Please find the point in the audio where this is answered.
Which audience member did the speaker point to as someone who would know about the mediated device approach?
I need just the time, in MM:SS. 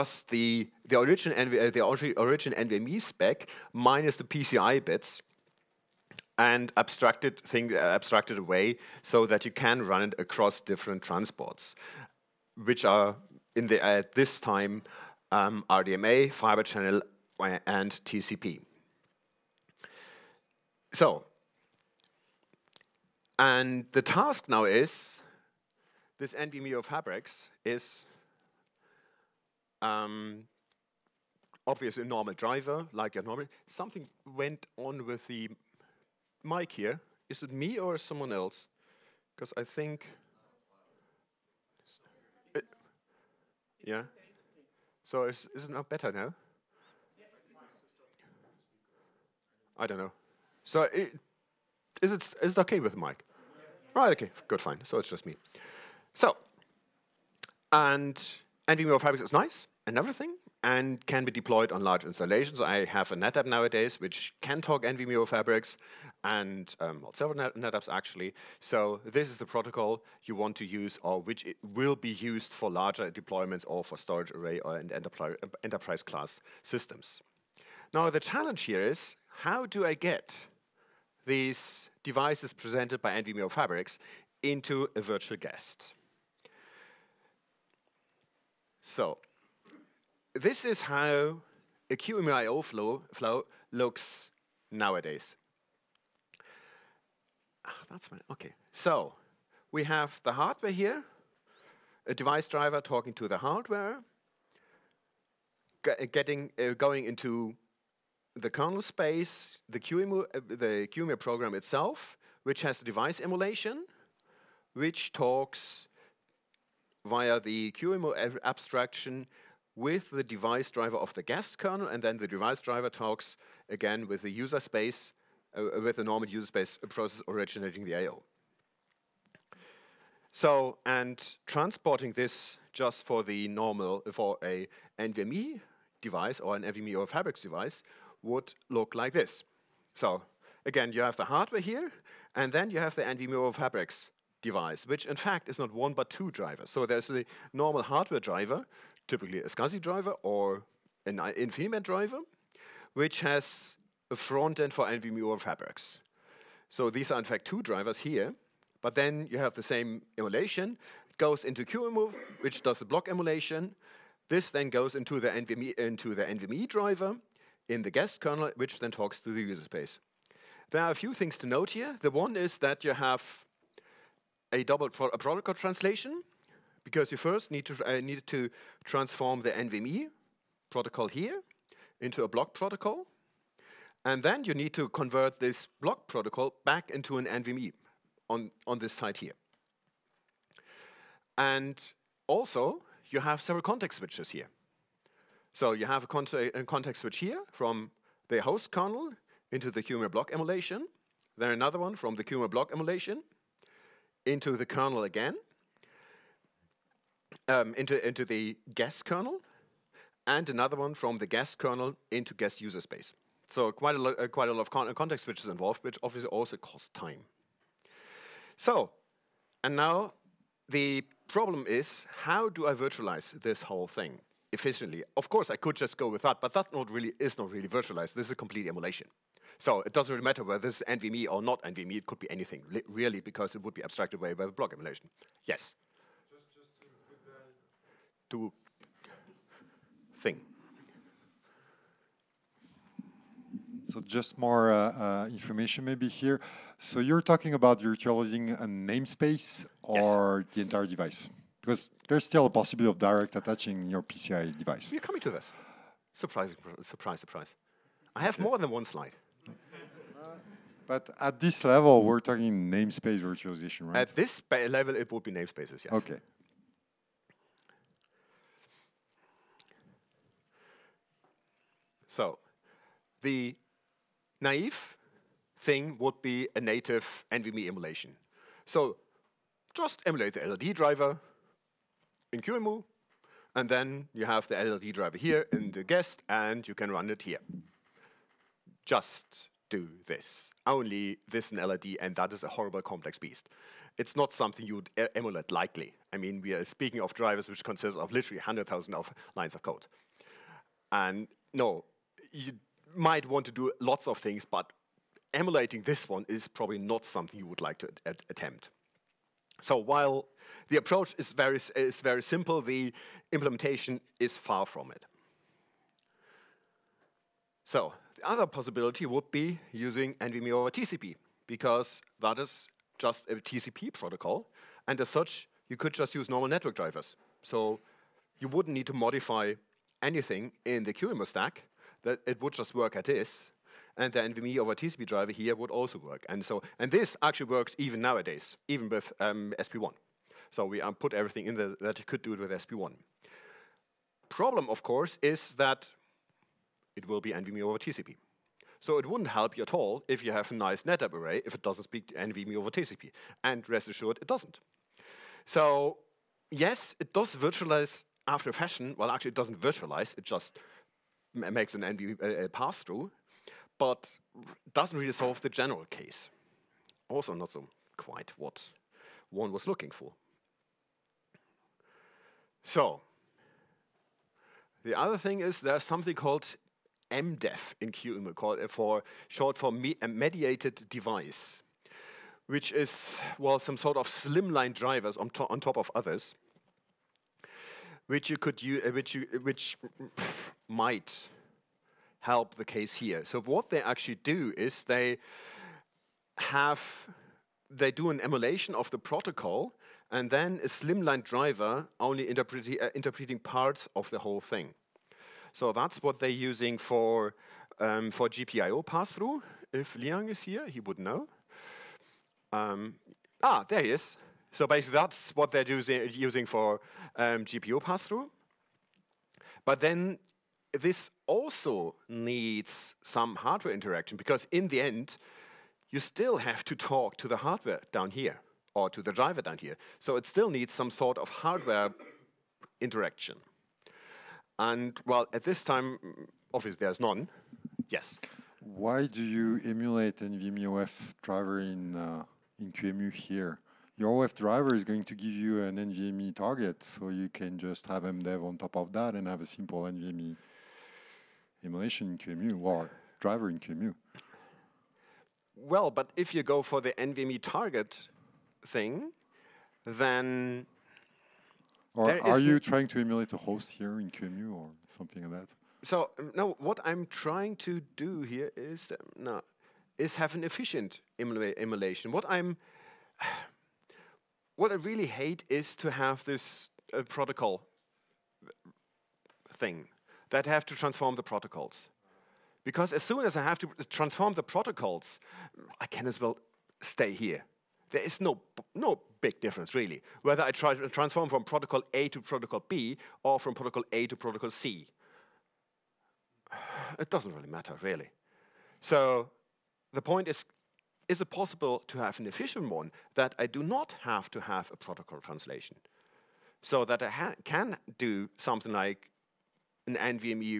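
06:49.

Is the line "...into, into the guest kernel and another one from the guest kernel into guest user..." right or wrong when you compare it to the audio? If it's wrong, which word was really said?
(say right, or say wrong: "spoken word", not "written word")
right.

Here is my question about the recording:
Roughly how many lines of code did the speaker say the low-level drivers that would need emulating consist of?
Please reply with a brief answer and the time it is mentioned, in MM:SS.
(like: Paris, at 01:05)
100,000, at 04:58.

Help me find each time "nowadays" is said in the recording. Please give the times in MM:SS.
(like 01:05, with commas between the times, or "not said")
01:03, 01:34, 05:37.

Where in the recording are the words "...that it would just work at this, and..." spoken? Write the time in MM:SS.
05:32.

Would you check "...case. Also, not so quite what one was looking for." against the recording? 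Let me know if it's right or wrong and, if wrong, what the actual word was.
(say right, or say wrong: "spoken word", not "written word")
right.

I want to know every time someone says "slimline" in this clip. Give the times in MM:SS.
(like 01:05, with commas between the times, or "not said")
06:24, 06:40.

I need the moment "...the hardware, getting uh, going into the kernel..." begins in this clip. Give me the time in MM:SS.
01:43.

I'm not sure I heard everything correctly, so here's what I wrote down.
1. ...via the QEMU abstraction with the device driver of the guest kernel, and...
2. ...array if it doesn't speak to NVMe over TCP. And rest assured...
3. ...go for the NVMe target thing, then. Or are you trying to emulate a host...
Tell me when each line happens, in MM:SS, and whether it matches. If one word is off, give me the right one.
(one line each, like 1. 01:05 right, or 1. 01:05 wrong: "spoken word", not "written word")
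1. 01:57 right
2. 05:51 right
3. 07:36 right.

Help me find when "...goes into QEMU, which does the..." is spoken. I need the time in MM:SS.
02:41.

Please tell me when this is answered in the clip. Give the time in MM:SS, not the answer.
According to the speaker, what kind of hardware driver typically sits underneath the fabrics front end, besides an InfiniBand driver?
02:29.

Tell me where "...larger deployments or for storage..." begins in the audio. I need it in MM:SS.
01:12.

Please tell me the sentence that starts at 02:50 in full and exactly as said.
There are a few things to note here.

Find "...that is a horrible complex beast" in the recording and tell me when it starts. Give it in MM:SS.
04:52.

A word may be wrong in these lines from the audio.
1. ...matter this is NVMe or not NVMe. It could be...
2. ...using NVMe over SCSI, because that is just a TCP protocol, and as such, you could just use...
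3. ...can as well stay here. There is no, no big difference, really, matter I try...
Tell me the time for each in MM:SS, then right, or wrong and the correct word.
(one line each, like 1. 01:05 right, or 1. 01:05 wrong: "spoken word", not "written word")
1. 03:50 wrong: "whether", not "matter"
2. 05:19 wrong: "TCP", not "SCSI"
3. 08:05 wrong: "whether", not "matter".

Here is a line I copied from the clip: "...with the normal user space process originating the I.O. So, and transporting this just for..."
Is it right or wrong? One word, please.
right.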